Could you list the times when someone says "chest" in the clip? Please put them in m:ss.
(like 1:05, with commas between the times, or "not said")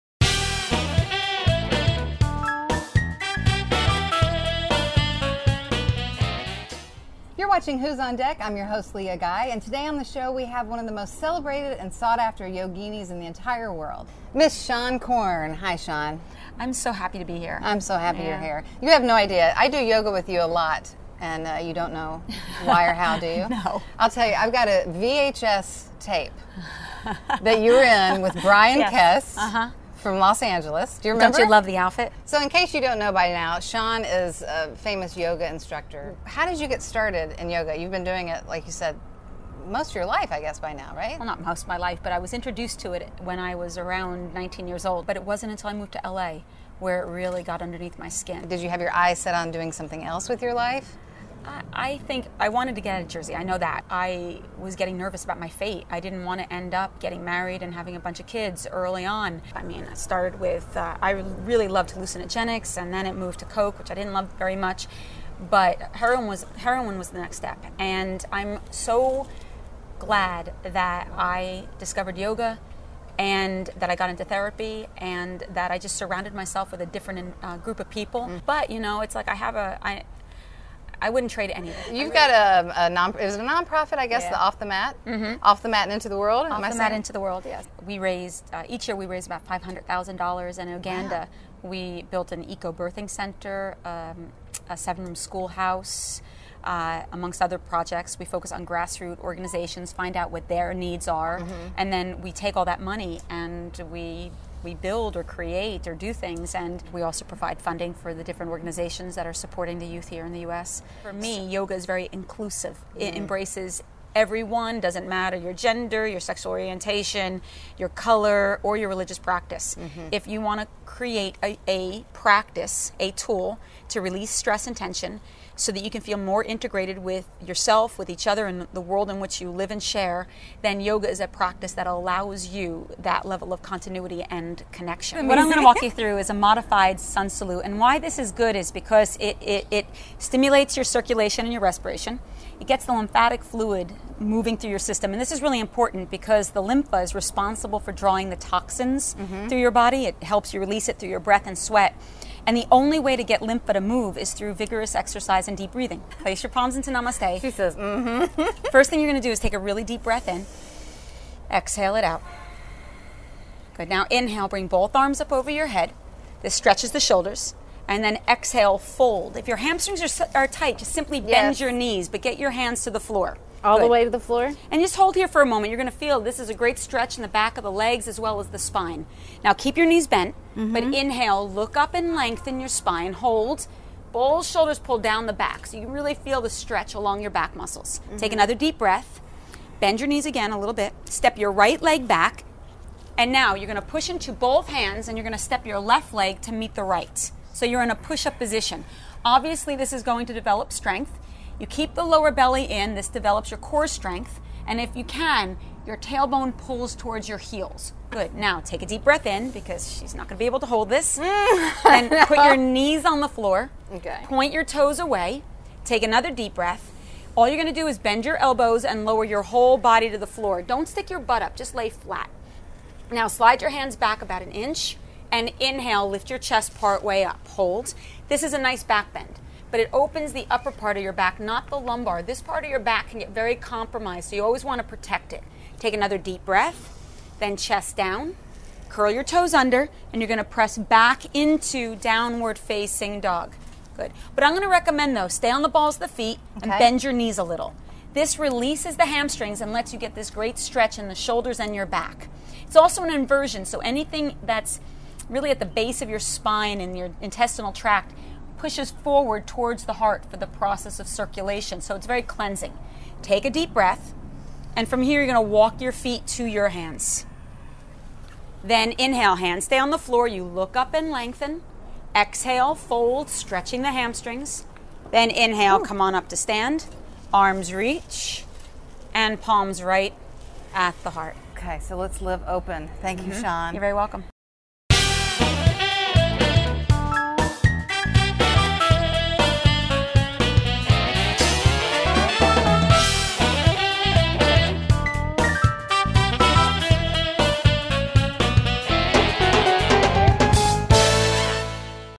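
3:46, 3:57.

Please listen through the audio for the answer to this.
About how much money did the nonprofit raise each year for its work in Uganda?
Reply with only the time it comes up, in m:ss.
1:29.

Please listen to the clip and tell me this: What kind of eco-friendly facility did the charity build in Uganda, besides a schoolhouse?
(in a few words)
eco birthing center.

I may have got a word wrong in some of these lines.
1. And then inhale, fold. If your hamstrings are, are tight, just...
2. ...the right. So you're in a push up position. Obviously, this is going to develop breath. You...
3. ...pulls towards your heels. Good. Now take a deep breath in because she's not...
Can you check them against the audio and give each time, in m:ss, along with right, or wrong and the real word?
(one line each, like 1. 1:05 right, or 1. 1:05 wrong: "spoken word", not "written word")
1. 2:47 wrong: "exhale", not "inhale"
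2. 3:16 wrong: "strength", not "breath"
3. 3:26 right.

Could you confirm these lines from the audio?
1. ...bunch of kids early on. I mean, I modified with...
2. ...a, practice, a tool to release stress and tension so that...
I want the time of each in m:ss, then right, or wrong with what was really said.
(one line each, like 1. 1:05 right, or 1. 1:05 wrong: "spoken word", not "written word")
1. 0:57 wrong: "started", not "modified"
2. 2:01 right.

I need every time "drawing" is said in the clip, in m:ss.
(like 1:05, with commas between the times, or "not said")
2:27.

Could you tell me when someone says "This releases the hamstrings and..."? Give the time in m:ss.
4:08.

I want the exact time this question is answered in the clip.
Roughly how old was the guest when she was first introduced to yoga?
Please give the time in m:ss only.
0:44.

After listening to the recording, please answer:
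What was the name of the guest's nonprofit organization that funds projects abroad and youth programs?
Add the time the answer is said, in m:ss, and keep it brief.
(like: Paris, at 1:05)
Off the Mat, Into the World, at 1:25.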